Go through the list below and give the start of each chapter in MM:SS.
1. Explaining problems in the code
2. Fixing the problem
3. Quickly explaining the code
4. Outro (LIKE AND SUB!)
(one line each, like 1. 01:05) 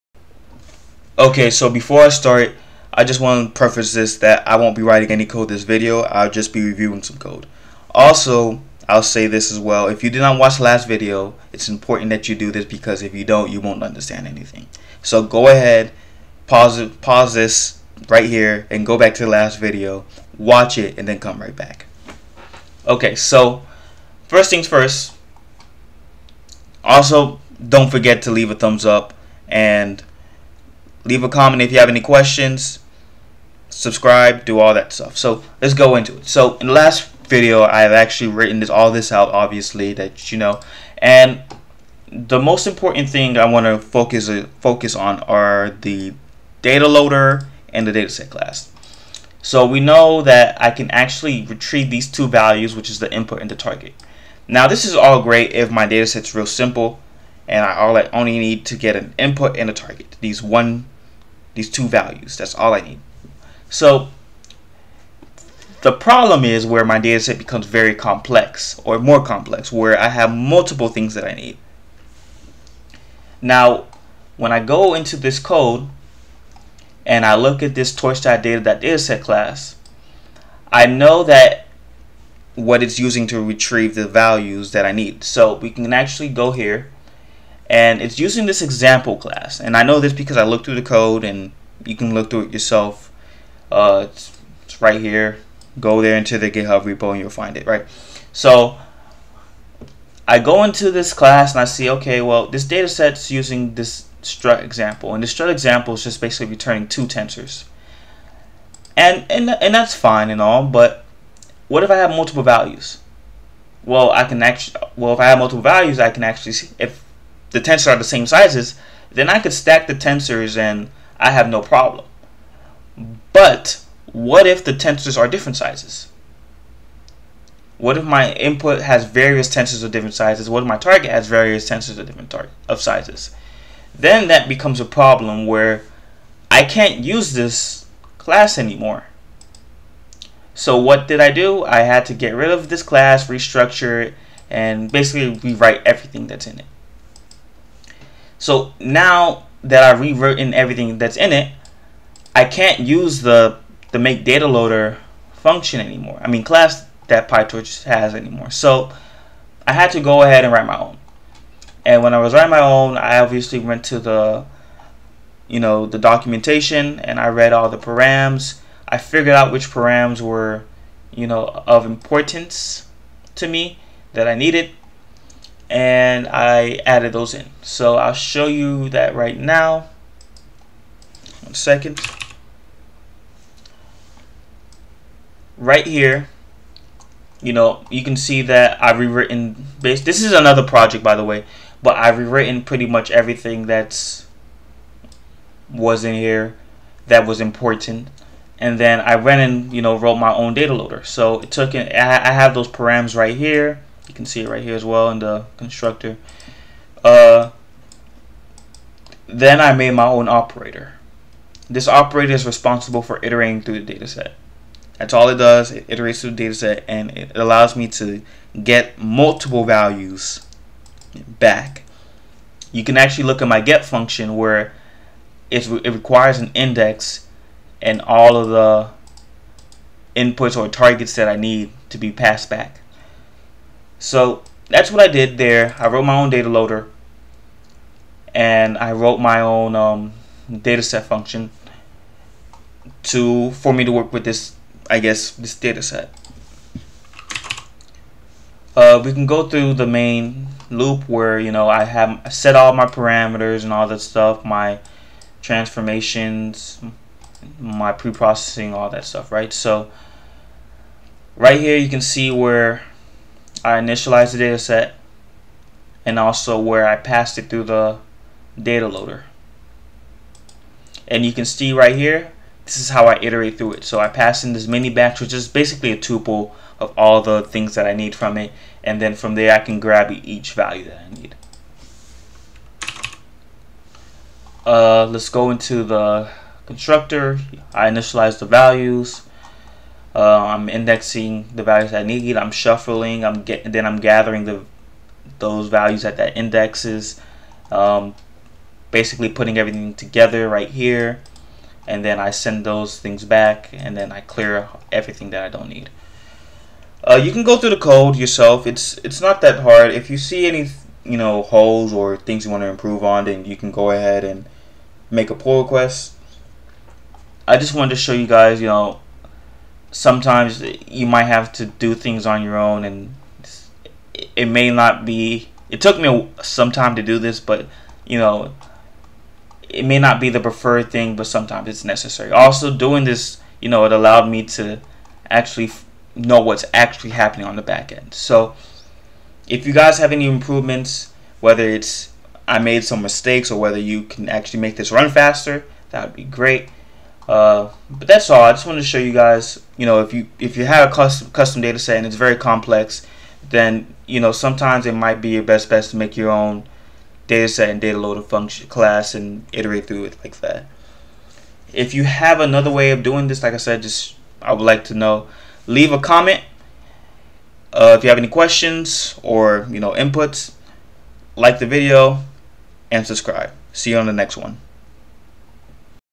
1. 00:36
2. 02:20
3. 04:43
4. 05:49.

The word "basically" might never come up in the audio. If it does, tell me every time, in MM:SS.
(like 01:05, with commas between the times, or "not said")
01:46, 02:24, 04:35, 04:58.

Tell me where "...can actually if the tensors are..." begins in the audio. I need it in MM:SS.
01:56.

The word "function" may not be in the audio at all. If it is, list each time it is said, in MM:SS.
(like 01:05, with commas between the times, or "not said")
02:35, 03:43, 04:01, 05:58.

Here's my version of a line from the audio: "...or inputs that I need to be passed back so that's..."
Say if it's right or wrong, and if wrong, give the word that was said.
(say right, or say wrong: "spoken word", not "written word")
wrong: "targets", not "inputs".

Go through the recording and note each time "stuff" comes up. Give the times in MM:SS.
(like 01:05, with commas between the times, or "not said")
00:34, 04:14, 04:19.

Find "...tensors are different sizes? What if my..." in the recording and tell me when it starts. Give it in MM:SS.
02:04.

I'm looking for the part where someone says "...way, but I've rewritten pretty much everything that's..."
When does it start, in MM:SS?
03:11.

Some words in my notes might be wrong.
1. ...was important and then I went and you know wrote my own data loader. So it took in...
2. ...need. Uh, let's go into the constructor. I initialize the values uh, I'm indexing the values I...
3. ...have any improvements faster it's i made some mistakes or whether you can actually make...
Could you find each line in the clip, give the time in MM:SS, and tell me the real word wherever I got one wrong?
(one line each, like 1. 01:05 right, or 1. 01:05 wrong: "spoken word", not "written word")
1. 03:17 right
2. 04:41 right
3. 05:39 wrong: "whether", not "faster".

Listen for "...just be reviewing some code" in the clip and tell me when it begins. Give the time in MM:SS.
00:06.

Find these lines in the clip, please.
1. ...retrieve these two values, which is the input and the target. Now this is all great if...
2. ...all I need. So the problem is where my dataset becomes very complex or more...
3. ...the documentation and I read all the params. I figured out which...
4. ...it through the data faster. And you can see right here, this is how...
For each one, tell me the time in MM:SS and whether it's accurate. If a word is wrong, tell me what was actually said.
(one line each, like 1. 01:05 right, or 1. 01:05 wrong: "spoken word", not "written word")
1. 00:51 right
2. 01:02 right
3. 02:45 right
4. 04:27 wrong: "loader", not "faster".